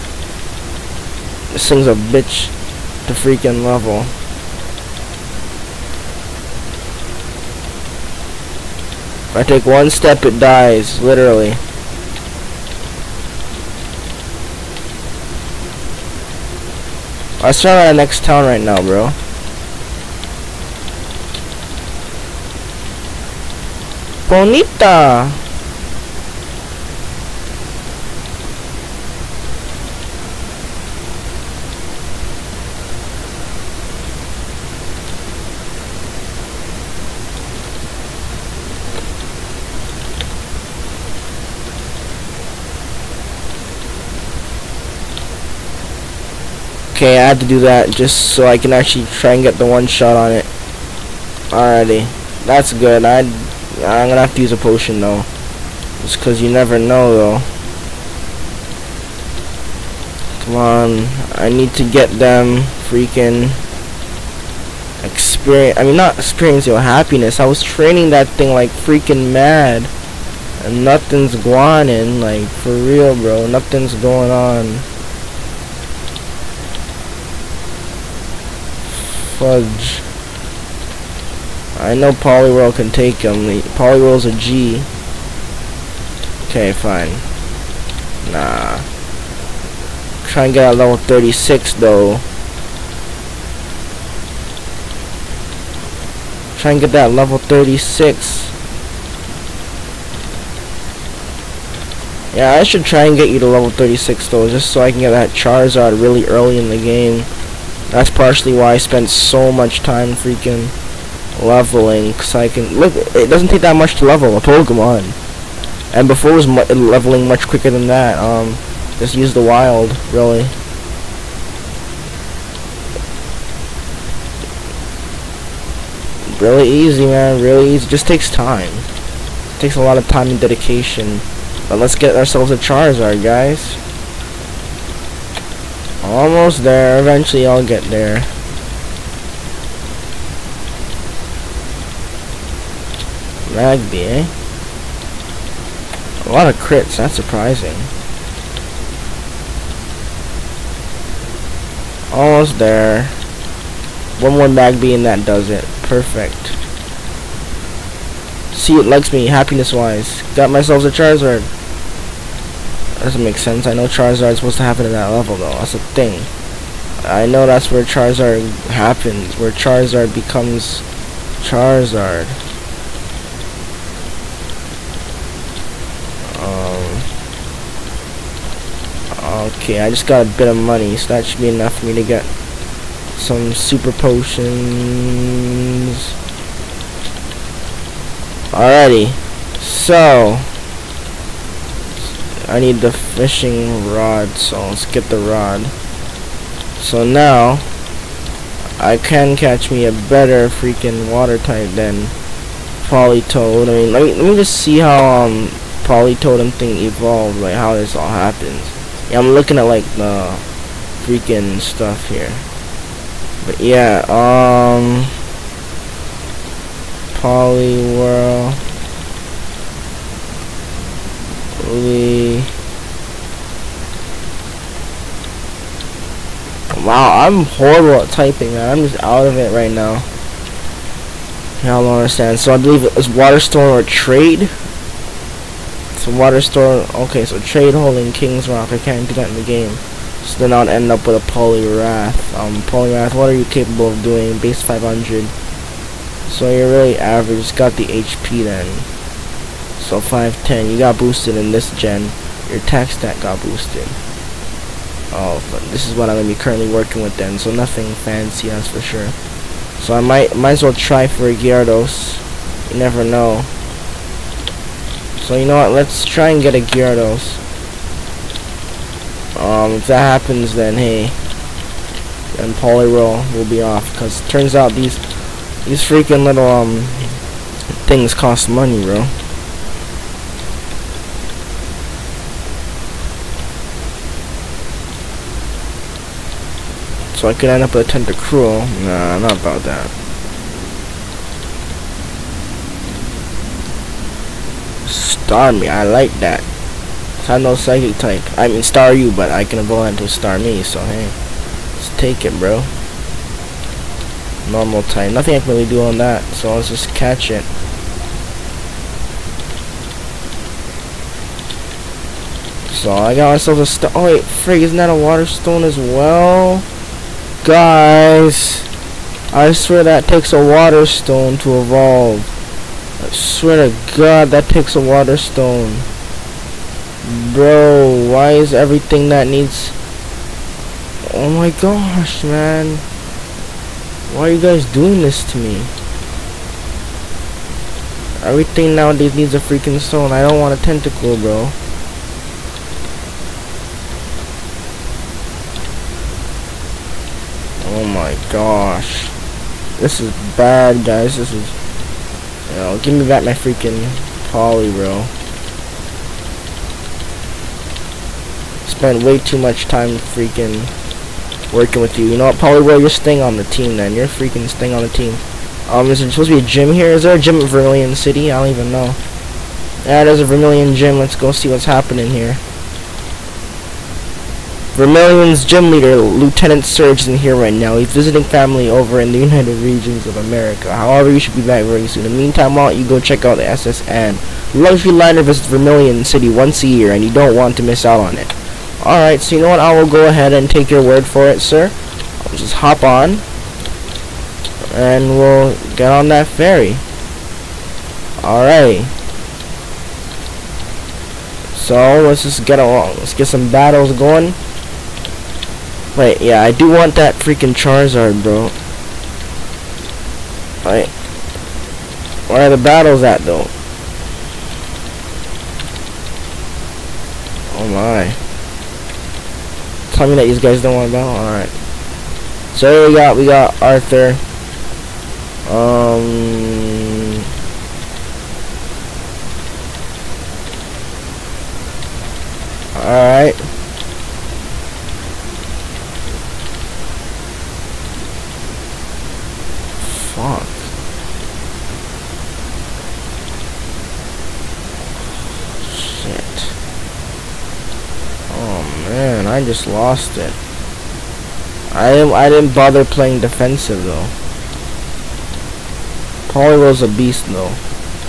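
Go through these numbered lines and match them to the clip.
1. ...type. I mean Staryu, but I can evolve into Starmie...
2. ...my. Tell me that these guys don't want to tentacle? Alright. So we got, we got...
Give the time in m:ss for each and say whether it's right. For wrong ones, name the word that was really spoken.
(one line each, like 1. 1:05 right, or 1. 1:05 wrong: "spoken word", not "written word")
1. 4:57 right
2. 6:57 wrong: "battle", not "tentacle".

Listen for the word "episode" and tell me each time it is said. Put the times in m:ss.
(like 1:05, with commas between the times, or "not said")
not said.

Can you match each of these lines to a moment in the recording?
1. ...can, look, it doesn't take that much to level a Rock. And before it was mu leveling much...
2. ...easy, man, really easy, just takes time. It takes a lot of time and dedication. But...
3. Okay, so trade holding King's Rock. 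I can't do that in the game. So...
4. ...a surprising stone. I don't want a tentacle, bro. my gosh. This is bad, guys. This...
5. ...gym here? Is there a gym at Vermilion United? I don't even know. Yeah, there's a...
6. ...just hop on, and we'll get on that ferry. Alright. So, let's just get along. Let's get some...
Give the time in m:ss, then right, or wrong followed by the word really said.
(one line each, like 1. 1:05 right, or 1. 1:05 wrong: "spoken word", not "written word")
1. 1:52 wrong: "Pokemon", not "Rock"
2. 2:06 right
3. 3:56 right
4. 5:39 wrong: "freaking", not "surprising"
5. 6:06 wrong: "City", not "United"
6. 6:32 right.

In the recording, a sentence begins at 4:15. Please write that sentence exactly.
Oh, but this is what I'm going to be currently working with then, so nothing fancy, that's for sure.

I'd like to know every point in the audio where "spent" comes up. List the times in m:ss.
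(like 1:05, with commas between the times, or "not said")
1:48, 5:58.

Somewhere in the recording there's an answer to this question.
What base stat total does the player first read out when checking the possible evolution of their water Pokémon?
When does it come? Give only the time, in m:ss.
4:04.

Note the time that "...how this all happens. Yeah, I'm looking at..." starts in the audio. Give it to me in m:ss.
3:27.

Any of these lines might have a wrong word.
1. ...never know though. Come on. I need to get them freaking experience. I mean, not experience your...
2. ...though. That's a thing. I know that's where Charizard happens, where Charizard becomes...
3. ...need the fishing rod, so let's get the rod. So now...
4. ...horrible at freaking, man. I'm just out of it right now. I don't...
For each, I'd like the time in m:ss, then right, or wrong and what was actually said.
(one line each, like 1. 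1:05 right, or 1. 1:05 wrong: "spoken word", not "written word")
1. 0:56 right
2. 2:45 right
3. 3:12 right
4. 3:47 wrong: "typing", not "freaking".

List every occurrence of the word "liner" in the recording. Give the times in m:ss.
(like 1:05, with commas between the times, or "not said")
6:24.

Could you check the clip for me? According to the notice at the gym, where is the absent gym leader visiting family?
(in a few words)
United Regions of America.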